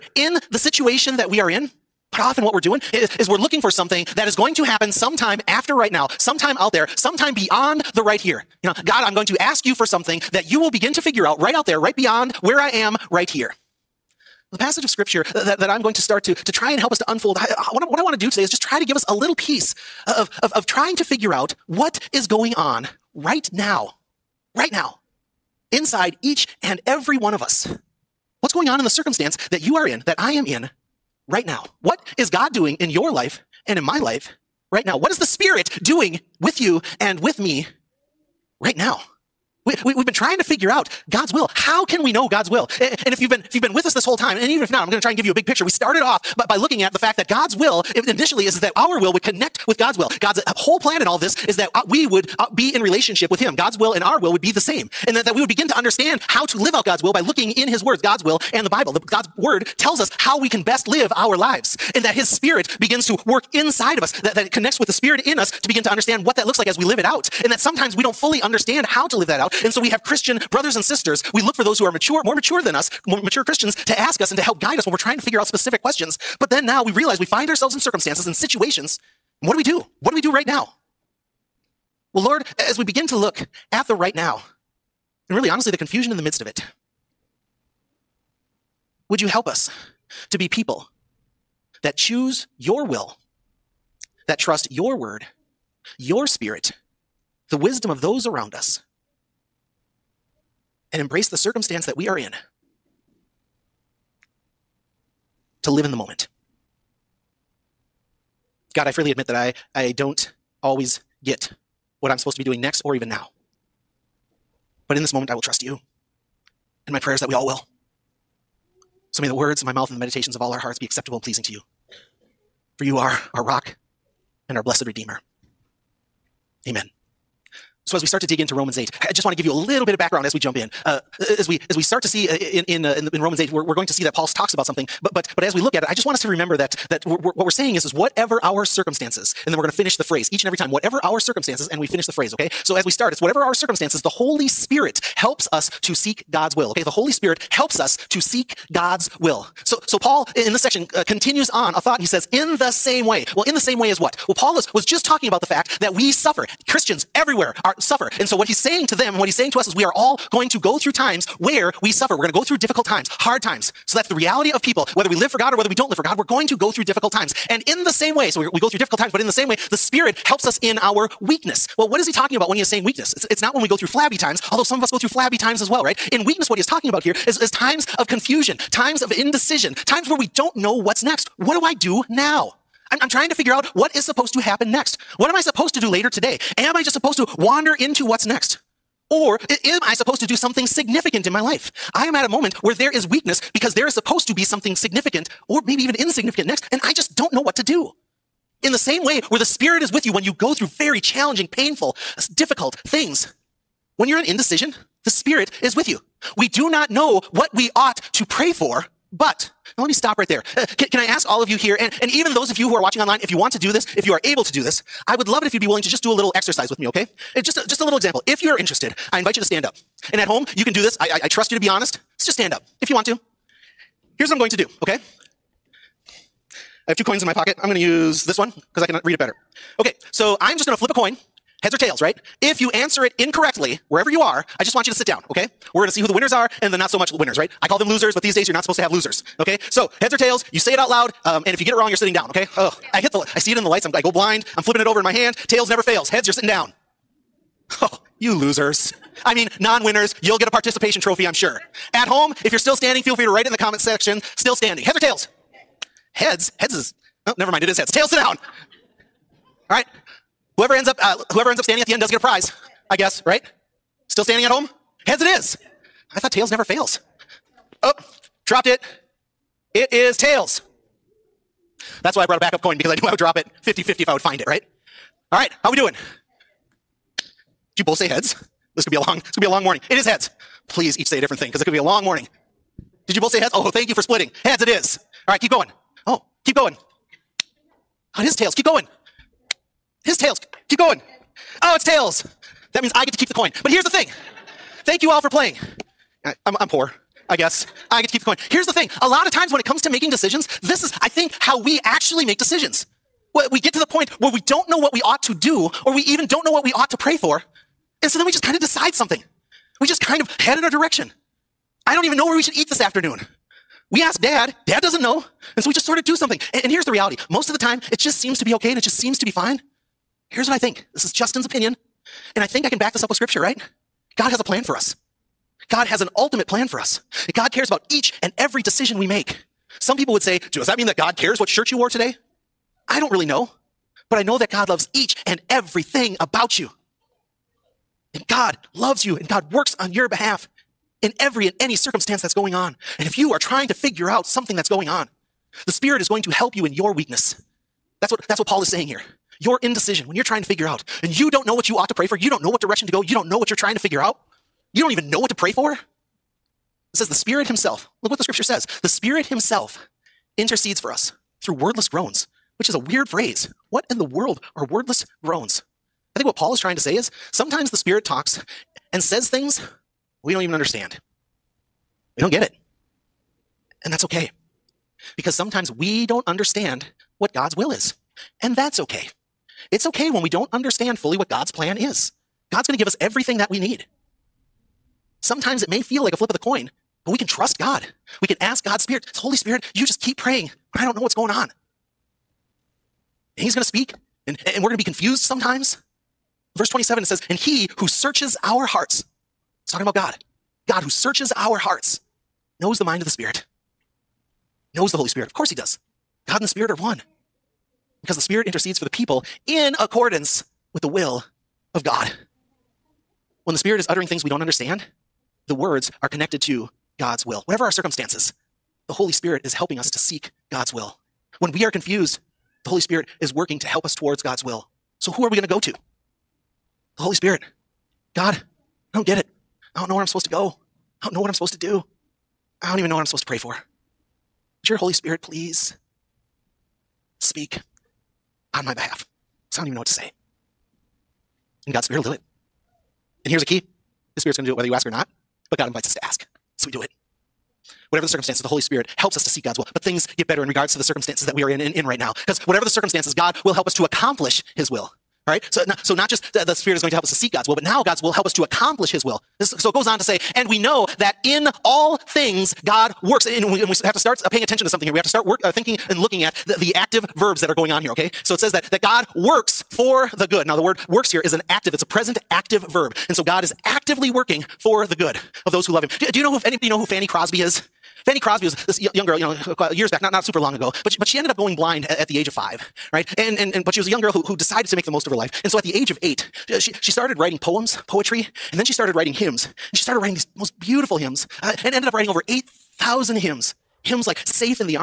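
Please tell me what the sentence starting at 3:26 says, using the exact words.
We do not know what we ought to pray for, but now let me stop right there.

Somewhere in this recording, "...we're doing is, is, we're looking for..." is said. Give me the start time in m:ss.
0:02.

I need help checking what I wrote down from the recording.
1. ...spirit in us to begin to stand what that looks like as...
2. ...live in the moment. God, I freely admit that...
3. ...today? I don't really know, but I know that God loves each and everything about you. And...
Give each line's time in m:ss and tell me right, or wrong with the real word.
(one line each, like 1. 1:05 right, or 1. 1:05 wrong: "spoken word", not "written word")
1. 1:04 wrong: "understand", not "stand"
2. 1:45 right
3. 5:31 right.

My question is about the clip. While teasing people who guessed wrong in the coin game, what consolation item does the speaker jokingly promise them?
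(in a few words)
participation trophy.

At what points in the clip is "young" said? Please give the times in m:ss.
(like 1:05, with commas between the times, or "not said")
7:58, 8:03.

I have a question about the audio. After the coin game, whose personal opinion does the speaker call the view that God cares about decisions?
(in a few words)
Justin's.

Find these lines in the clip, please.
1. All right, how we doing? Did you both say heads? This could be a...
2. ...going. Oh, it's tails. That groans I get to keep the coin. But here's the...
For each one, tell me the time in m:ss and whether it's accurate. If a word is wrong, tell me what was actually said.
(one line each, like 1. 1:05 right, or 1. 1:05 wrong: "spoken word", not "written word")
1. 4:35 right
2. 4:50 wrong: "means", not "groans".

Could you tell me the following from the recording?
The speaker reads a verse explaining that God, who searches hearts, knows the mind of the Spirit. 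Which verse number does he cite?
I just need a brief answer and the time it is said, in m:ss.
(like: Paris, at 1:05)
Verse 27, at 6:36.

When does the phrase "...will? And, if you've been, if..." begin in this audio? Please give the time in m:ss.
0:42.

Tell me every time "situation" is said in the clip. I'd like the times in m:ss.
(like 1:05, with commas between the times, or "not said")
0:00, 1:18.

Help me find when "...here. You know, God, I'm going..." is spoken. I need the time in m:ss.
0:08.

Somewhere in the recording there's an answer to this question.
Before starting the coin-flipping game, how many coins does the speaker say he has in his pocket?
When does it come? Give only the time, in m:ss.
3:46.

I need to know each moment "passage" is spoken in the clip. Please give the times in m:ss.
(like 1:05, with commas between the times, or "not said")
0:14.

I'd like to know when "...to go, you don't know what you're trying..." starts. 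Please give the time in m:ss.
5:52.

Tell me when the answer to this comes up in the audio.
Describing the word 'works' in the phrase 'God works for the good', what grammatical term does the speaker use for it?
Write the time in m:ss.
7:51.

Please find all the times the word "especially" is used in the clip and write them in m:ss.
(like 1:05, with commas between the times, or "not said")
not said.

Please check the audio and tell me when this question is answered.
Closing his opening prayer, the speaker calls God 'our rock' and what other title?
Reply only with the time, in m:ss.
2:04.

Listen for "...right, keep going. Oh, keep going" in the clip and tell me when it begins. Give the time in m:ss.
4:45.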